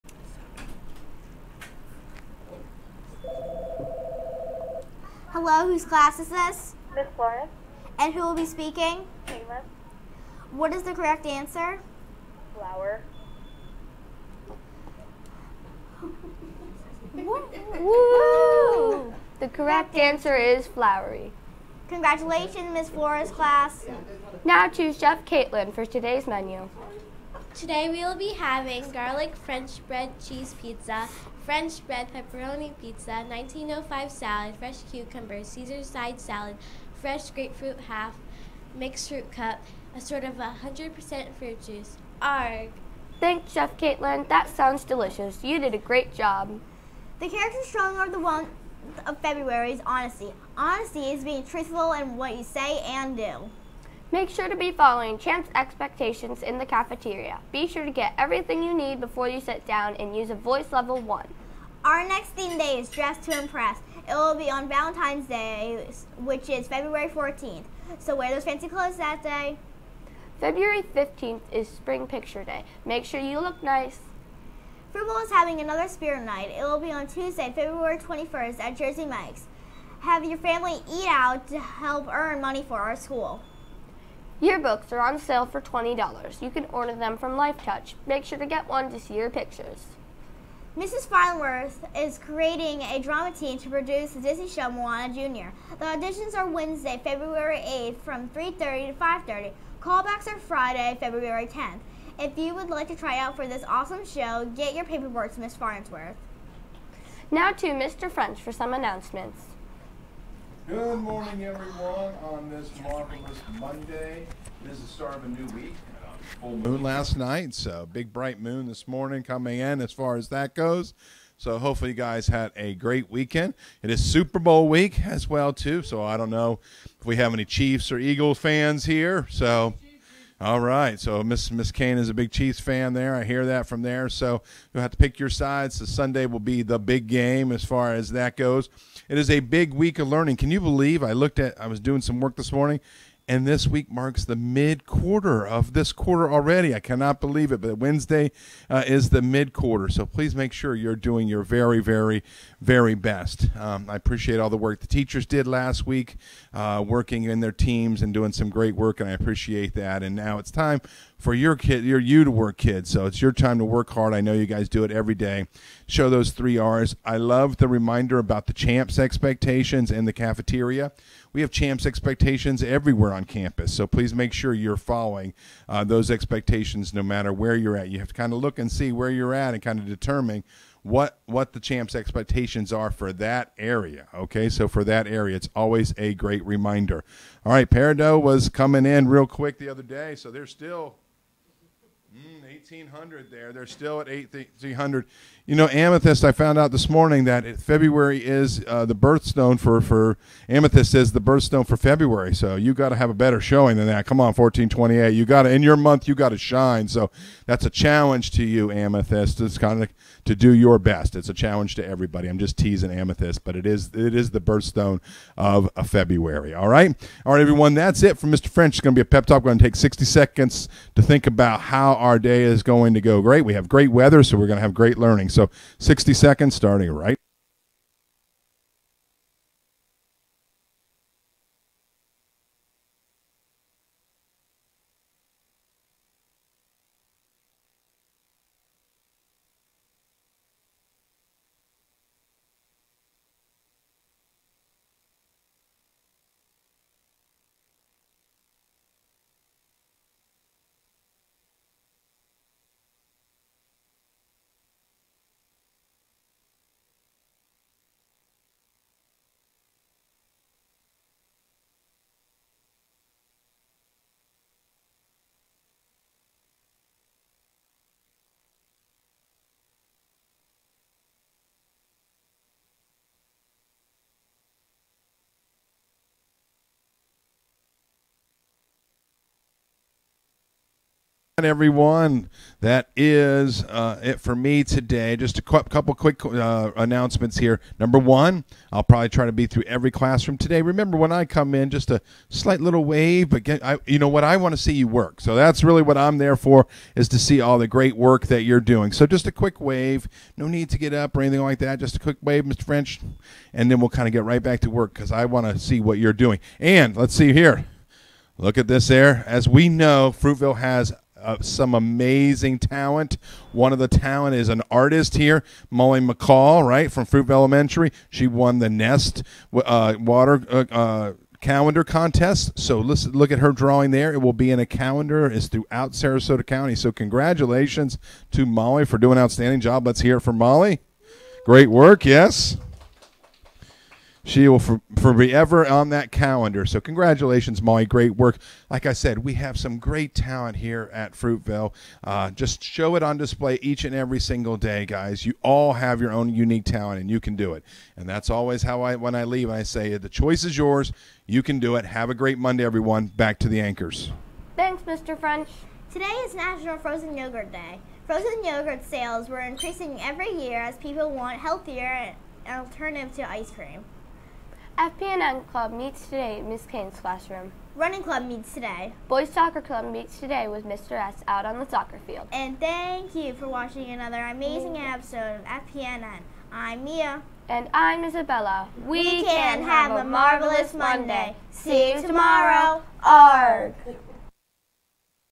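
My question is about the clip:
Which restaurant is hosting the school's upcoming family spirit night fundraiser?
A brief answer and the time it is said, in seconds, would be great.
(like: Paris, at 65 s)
Jersey Mike's, at 78 s.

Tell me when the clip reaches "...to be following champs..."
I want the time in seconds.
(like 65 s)
54 s.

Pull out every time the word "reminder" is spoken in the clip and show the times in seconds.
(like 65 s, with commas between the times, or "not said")
167 s, 186 s.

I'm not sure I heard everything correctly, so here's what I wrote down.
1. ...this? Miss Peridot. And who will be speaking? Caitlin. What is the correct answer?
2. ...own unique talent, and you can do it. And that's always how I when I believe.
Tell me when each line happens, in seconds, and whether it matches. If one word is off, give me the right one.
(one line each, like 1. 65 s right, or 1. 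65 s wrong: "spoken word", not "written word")
1. 6 s wrong: "Flores", not "Peridot"
2. 346 s wrong: "leave", not "believe".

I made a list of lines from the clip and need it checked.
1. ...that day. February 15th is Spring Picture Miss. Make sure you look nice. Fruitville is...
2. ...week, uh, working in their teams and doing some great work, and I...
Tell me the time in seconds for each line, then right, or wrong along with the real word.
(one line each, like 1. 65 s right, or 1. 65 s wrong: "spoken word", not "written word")
1. 68 s wrong: "Day", not "Miss"
2. 155 s right.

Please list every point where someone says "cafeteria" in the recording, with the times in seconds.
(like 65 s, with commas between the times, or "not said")
56 s, 170 s.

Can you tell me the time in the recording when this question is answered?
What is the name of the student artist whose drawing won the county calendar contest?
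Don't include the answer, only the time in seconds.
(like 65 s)
315 s.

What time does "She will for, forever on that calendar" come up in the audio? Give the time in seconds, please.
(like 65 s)
334 s.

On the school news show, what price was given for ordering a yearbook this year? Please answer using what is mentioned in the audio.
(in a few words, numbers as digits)
$20.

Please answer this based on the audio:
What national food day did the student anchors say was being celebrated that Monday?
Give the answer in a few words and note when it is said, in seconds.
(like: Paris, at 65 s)
National Frozen Yogurt Day, at 356 s.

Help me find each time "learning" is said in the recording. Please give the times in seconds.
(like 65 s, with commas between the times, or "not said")
140 s, 224 s.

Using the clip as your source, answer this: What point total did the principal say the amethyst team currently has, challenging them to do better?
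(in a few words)
1428.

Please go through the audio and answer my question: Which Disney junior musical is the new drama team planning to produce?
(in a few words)
Moana Jr.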